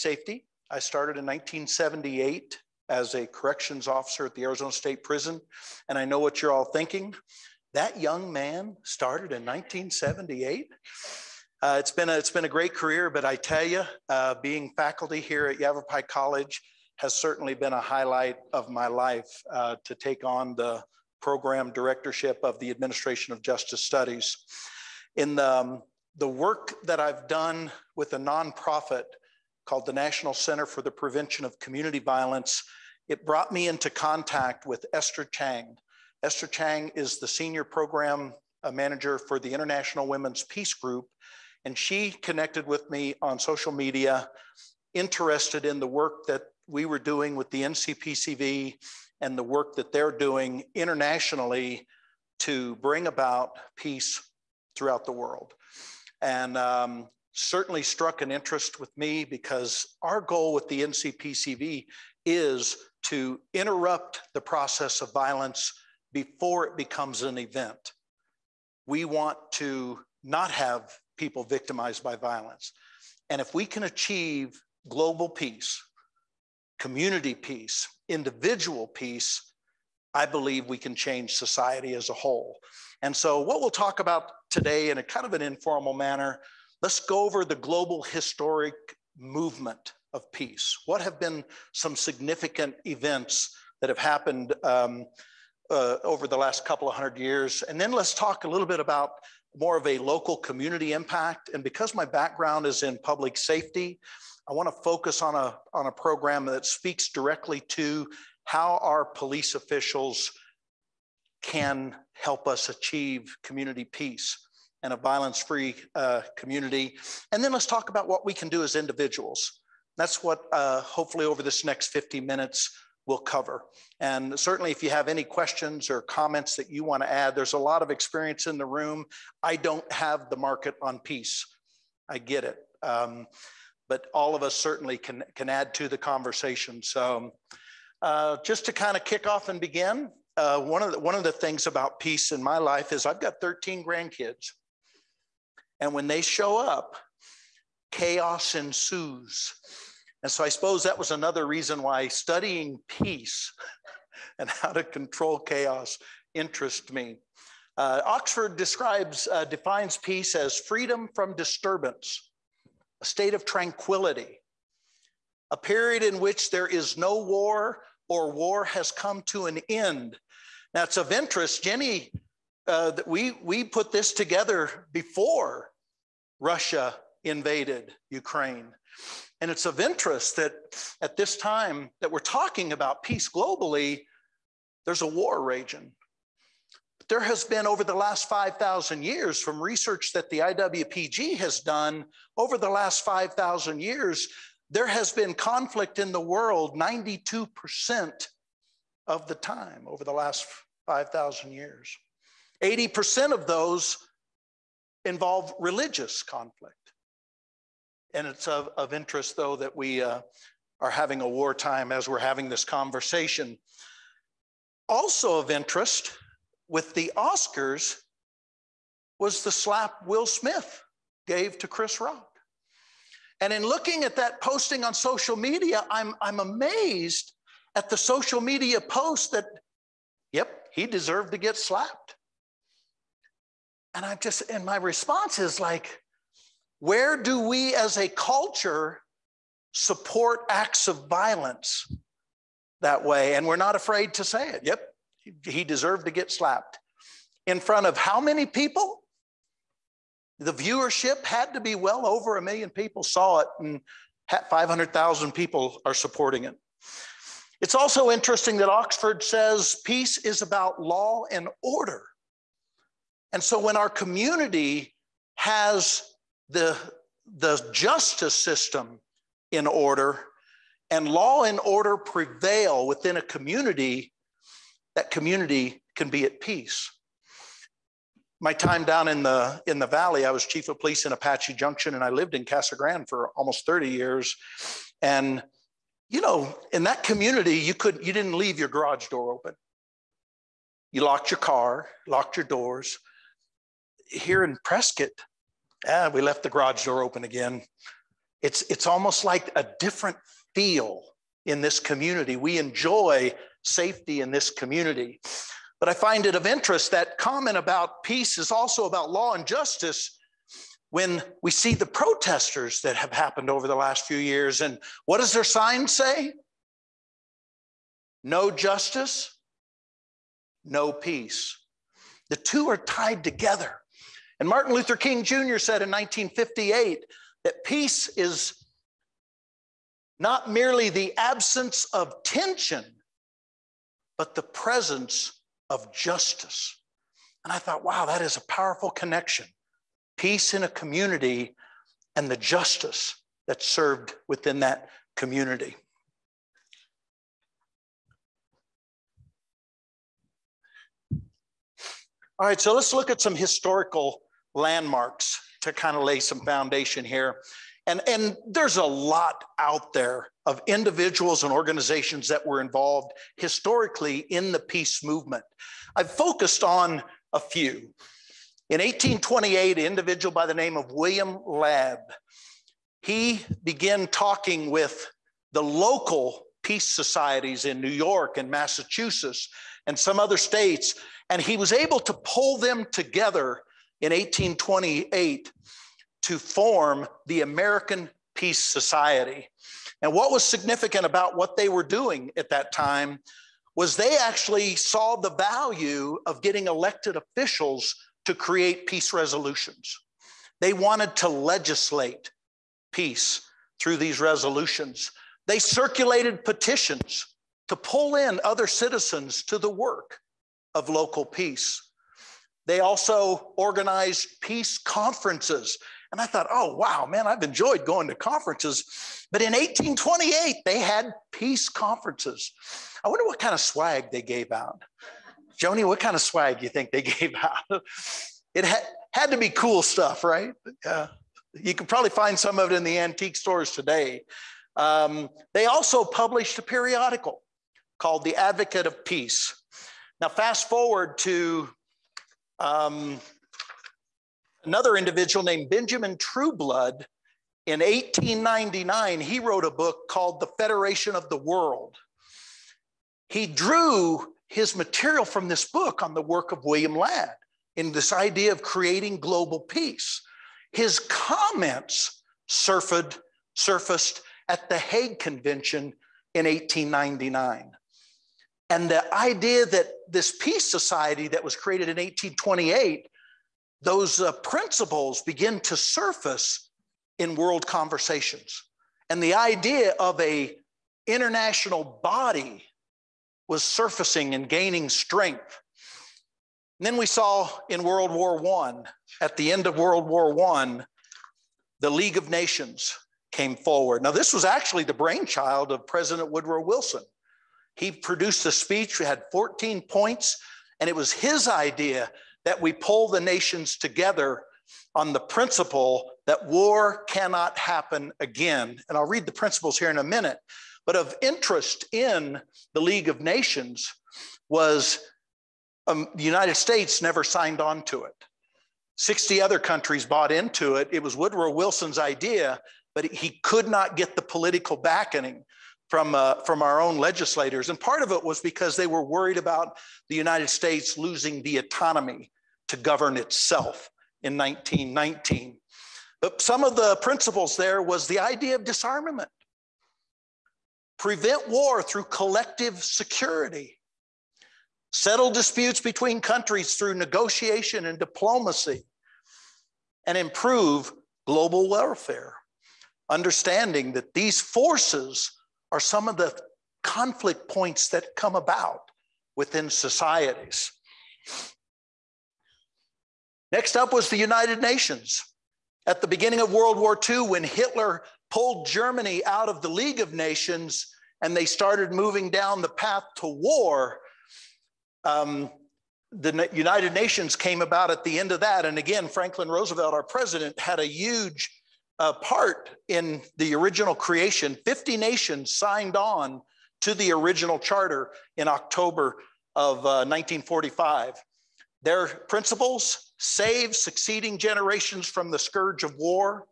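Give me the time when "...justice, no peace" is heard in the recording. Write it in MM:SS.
05:18.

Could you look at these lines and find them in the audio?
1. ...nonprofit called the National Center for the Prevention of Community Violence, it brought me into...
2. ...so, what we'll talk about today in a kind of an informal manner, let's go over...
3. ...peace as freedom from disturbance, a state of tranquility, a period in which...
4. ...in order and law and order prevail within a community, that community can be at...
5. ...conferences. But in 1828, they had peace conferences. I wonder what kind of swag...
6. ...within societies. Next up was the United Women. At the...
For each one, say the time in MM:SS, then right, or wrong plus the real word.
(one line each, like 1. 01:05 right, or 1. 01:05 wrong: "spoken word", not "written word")
1. 00:28 right
2. 01:23 right
3. 02:39 right
4. 04:29 right
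5. 06:58 right
6. 09:19 wrong: "Nations", not "Women".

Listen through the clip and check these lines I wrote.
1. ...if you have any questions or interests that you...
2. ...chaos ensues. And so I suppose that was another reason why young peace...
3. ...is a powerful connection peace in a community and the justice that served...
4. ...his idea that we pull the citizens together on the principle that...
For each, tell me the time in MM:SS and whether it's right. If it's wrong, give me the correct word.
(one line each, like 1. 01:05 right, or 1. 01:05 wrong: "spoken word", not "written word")
1. 02:04 wrong: "comments", not "interests"
2. 02:27 wrong: "studying", not "young"
3. 05:38 right
4. 08:21 wrong: "nations", not "citizens".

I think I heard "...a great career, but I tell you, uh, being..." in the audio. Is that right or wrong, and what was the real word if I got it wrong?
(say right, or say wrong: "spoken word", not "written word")
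right.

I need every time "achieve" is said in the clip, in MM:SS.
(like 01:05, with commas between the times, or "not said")
01:13, 01:52.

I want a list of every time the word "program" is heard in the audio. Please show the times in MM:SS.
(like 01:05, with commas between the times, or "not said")
00:21, 00:37, 01:45.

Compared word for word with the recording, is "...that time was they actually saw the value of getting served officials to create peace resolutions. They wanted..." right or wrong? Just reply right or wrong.
wrong.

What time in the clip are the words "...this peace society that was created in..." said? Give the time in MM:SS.
07:50.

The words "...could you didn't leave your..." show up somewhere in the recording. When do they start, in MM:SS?
04:47.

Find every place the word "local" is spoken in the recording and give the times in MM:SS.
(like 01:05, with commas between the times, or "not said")
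01:39, 06:15, 06:50.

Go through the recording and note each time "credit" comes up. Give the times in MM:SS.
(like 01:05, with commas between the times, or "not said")
not said.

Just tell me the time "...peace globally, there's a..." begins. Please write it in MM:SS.
03:03.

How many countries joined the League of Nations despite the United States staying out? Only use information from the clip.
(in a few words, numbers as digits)
60.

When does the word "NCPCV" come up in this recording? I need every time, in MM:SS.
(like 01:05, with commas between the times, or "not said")
00:47, 01:00.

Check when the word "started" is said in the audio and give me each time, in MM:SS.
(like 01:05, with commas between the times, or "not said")
00:00, 00:08, 09:31.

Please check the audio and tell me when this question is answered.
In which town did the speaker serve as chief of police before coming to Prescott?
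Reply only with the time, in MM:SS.
04:41.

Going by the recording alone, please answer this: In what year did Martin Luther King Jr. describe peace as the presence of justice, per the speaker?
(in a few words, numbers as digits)
1958.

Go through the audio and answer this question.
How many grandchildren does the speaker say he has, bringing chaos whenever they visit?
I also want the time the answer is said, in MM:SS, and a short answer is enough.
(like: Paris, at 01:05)
13, at 02:23.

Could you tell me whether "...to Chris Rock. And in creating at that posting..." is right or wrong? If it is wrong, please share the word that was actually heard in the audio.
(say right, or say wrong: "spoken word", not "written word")
wrong: "looking", not "creating".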